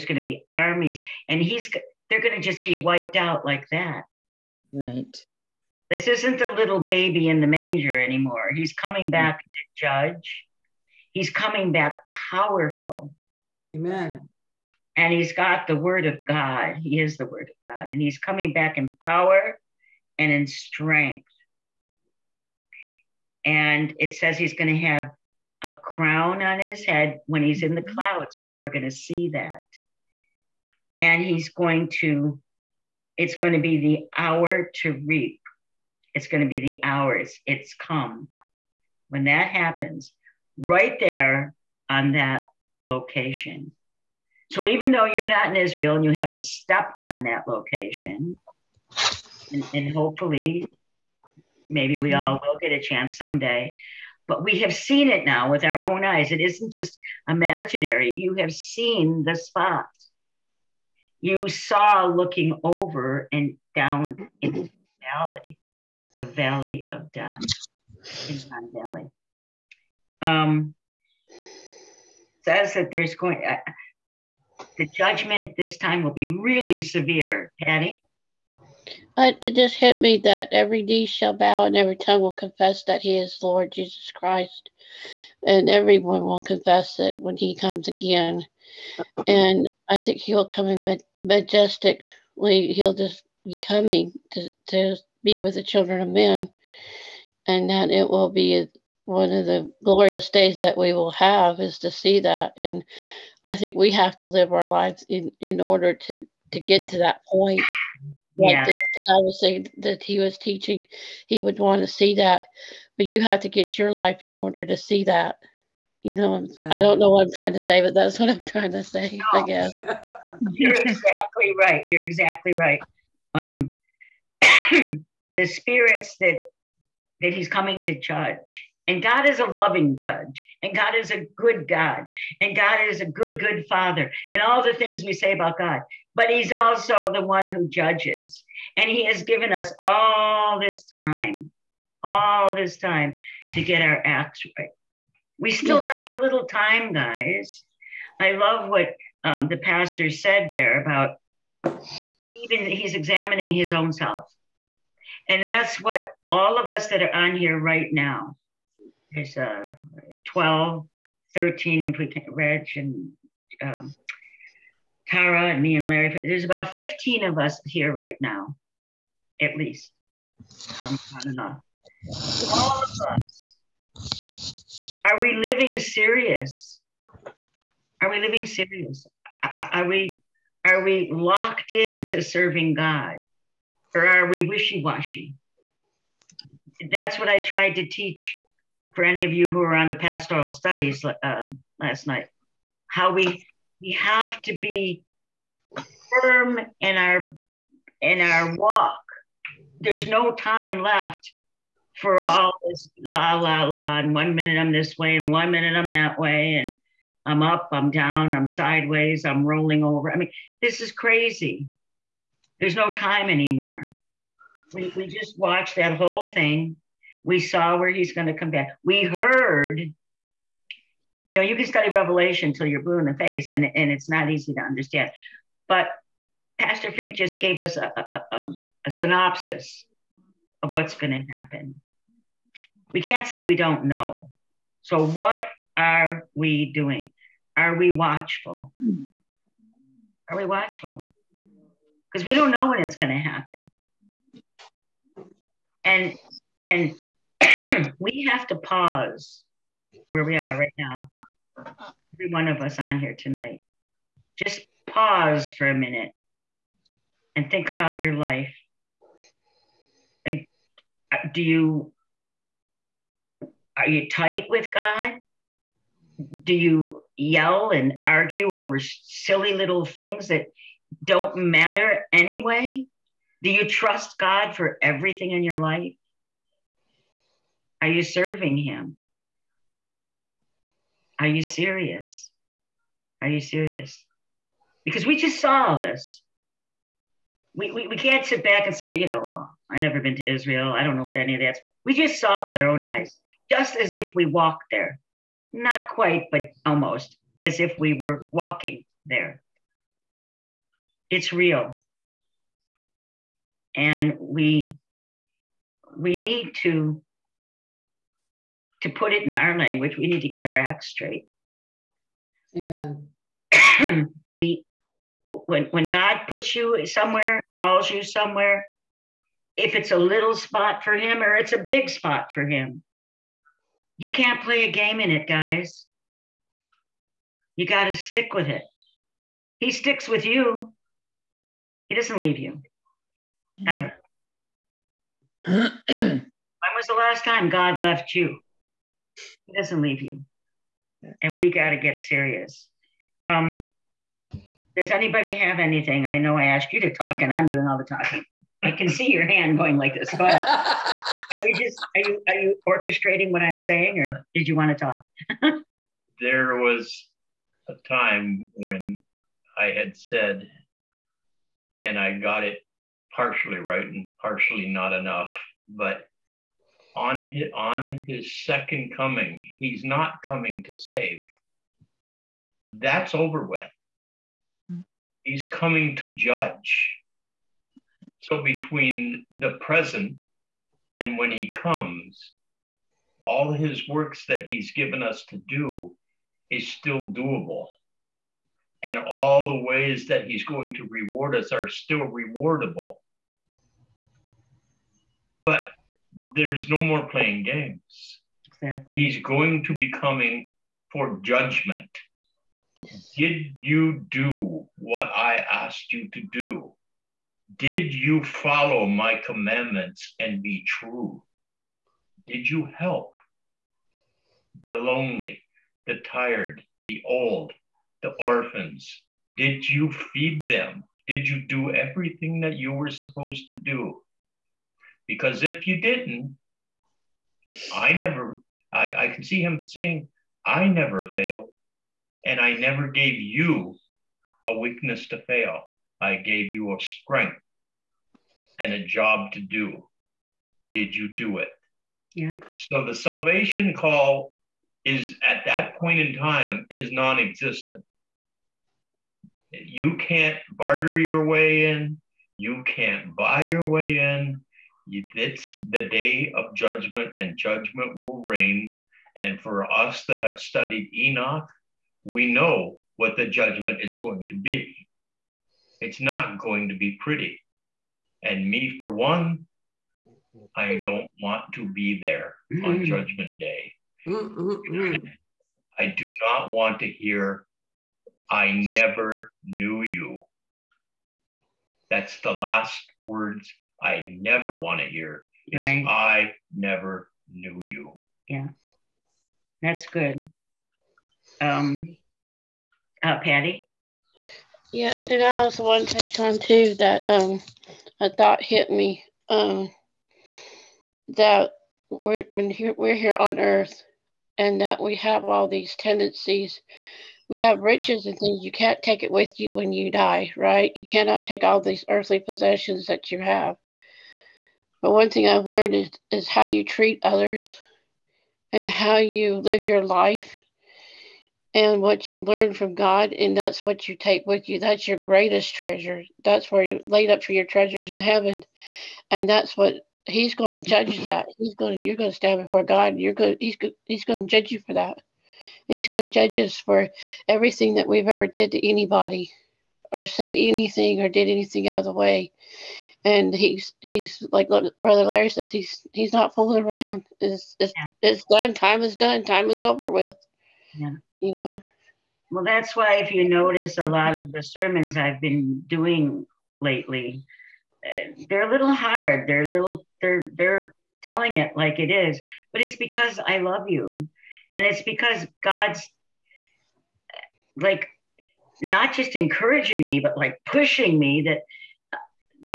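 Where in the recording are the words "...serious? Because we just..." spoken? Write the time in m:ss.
4:43.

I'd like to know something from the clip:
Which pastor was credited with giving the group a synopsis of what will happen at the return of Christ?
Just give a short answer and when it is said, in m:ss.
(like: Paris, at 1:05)
Pastor Fink, at 3:46.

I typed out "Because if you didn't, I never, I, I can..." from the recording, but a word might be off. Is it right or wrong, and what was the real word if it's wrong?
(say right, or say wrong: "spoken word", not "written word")
right.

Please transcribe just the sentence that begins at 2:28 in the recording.
I love what um, the pastor said there about even he's examining his own self.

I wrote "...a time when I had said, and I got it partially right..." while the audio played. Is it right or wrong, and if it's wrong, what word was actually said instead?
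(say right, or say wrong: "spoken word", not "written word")
right.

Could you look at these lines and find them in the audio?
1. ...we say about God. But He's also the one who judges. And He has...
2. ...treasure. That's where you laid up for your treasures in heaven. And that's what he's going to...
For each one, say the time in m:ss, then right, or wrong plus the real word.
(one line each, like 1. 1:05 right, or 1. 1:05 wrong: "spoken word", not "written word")
1. 2:15 right
2. 8:45 right.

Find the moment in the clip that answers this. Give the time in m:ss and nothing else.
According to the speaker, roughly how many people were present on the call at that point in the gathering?
2:46.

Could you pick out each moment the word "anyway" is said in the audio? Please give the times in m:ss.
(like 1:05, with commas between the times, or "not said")
4:32.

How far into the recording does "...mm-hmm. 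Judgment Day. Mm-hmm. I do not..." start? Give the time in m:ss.
7:52.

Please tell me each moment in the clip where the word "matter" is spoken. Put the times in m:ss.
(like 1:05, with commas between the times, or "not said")
4:31.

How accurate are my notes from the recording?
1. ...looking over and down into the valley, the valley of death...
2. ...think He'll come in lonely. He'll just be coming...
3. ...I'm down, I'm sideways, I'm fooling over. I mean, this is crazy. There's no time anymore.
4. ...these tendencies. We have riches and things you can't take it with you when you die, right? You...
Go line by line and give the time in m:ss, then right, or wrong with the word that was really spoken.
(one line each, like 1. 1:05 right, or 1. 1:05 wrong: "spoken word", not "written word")
1. 1:02 right
2. 1:29 wrong: "majestically", not "lonely"
3. 3:27 wrong: "rolling", not "fooling"
4. 8:25 right.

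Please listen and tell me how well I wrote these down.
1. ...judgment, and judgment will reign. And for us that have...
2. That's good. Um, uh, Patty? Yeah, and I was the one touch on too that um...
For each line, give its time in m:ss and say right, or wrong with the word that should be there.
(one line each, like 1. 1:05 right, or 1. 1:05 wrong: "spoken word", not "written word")
1. 7:36 right
2. 8:09 right.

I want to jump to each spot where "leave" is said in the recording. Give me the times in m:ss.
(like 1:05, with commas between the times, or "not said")
5:32, 5:39.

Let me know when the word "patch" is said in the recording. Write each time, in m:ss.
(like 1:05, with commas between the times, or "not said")
not said.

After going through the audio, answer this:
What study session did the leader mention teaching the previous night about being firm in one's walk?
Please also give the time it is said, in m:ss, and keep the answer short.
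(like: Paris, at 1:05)
pastoral studies, at 3:09.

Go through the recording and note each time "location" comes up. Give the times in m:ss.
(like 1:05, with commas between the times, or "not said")
0:42, 0:47.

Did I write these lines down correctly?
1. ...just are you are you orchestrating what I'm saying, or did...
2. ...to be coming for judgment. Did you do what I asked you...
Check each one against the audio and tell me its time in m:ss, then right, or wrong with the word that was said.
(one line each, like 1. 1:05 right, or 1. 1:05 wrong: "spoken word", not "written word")
1. 5:51 right
2. 6:39 right.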